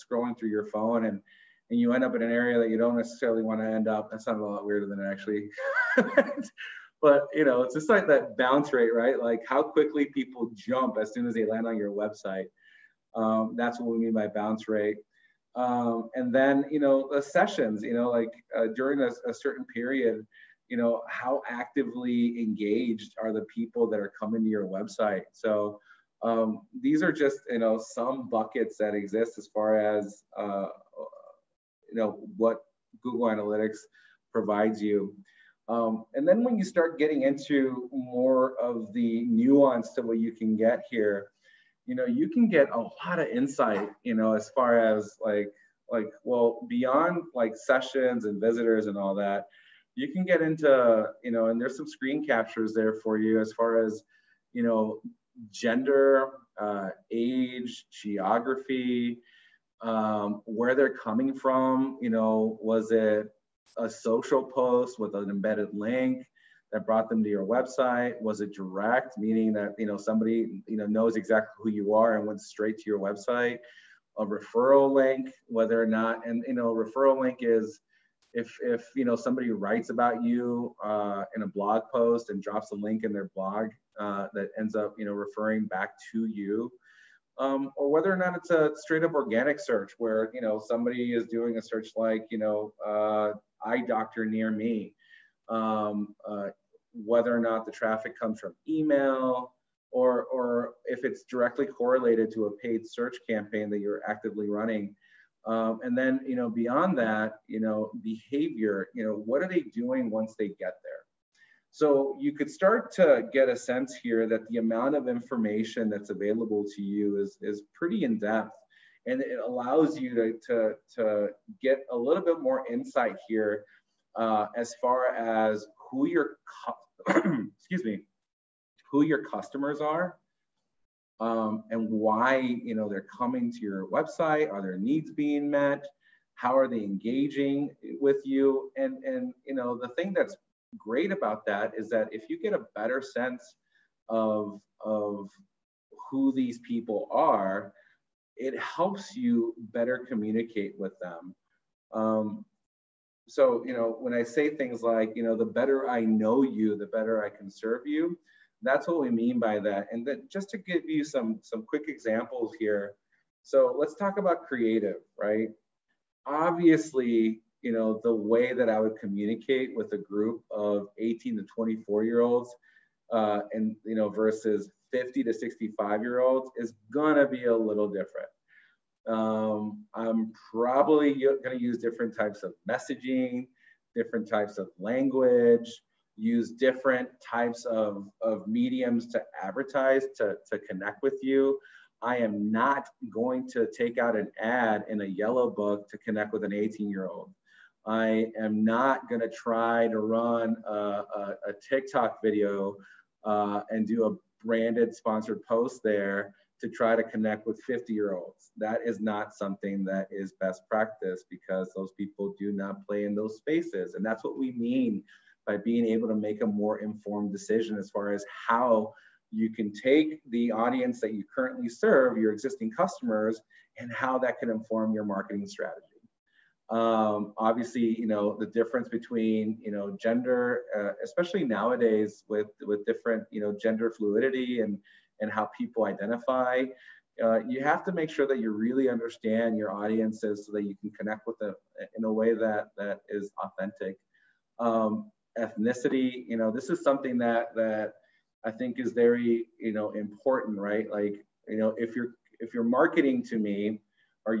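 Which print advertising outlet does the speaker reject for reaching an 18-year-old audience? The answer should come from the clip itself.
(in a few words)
yellow book.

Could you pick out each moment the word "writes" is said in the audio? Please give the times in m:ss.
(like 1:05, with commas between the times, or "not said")
1:19.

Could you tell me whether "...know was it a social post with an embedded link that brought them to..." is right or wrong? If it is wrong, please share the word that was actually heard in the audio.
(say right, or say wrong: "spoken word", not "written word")
right.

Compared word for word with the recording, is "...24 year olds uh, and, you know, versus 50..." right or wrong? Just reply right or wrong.
right.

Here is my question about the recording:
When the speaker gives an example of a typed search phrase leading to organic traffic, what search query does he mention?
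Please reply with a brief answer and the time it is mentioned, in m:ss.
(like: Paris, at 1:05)
eye doctor near me, at 1:33.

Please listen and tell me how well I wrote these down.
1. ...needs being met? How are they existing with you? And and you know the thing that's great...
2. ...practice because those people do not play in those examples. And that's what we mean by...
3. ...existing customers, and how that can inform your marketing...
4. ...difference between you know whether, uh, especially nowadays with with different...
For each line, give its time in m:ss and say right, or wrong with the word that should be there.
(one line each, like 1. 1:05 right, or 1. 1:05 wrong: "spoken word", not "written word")
1. 2:14 wrong: "engaging", not "existing"
2. 3:30 wrong: "spaces", not "examples"
3. 3:42 right
4. 3:48 wrong: "gender", not "whether".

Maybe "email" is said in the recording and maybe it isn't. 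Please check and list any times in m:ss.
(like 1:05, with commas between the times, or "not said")
1:38.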